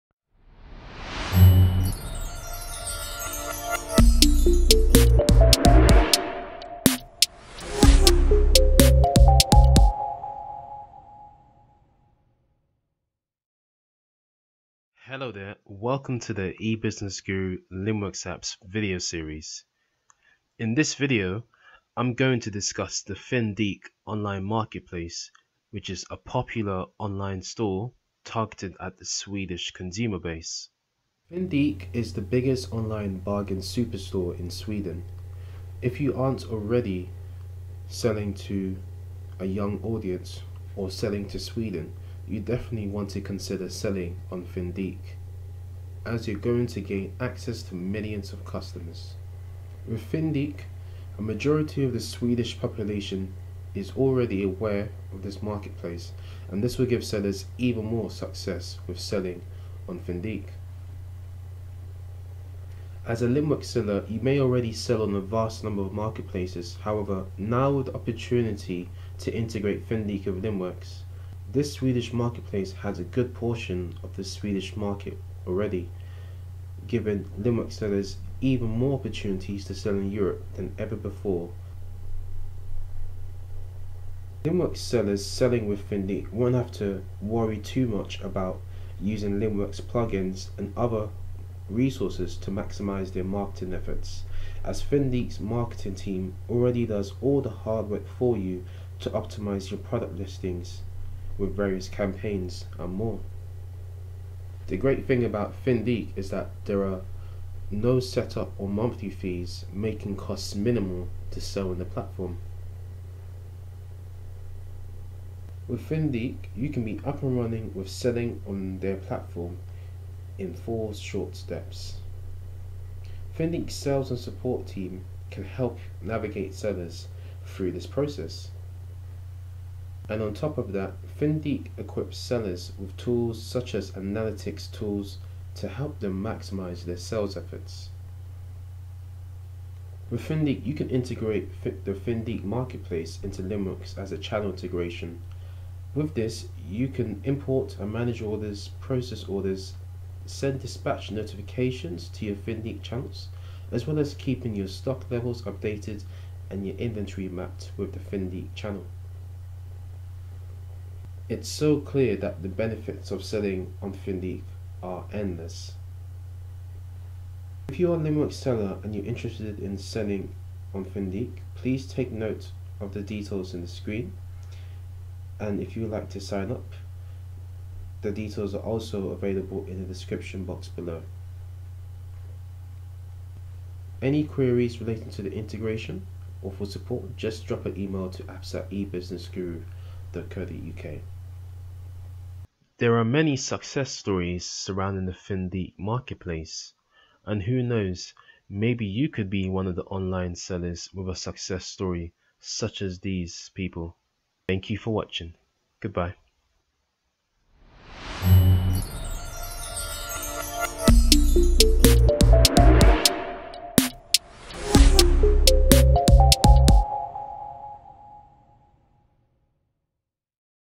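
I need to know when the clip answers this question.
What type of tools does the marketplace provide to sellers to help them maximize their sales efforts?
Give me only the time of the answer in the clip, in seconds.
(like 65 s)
133 s.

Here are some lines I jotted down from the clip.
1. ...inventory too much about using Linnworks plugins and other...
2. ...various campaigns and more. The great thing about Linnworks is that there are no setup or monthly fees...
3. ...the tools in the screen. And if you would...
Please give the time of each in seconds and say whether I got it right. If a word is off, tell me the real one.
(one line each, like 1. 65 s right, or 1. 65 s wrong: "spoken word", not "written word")
1. 87 s wrong: "worry", not "inventory"
2. 101 s wrong: "Fyndiq", not "Linnworks"
3. 172 s wrong: "details", not "tools".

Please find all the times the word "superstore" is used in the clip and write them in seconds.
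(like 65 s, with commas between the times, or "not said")
33 s.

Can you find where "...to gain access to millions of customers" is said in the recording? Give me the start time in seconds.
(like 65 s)
46 s.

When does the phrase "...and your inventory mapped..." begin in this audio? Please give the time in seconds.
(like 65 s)
156 s.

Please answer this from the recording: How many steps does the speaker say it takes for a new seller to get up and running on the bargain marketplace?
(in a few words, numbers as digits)
4.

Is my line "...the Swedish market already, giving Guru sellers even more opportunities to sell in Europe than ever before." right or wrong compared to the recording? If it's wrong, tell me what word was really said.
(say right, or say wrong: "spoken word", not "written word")
wrong: "Linnworks", not "Guru".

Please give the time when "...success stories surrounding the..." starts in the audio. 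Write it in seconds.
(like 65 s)
193 s.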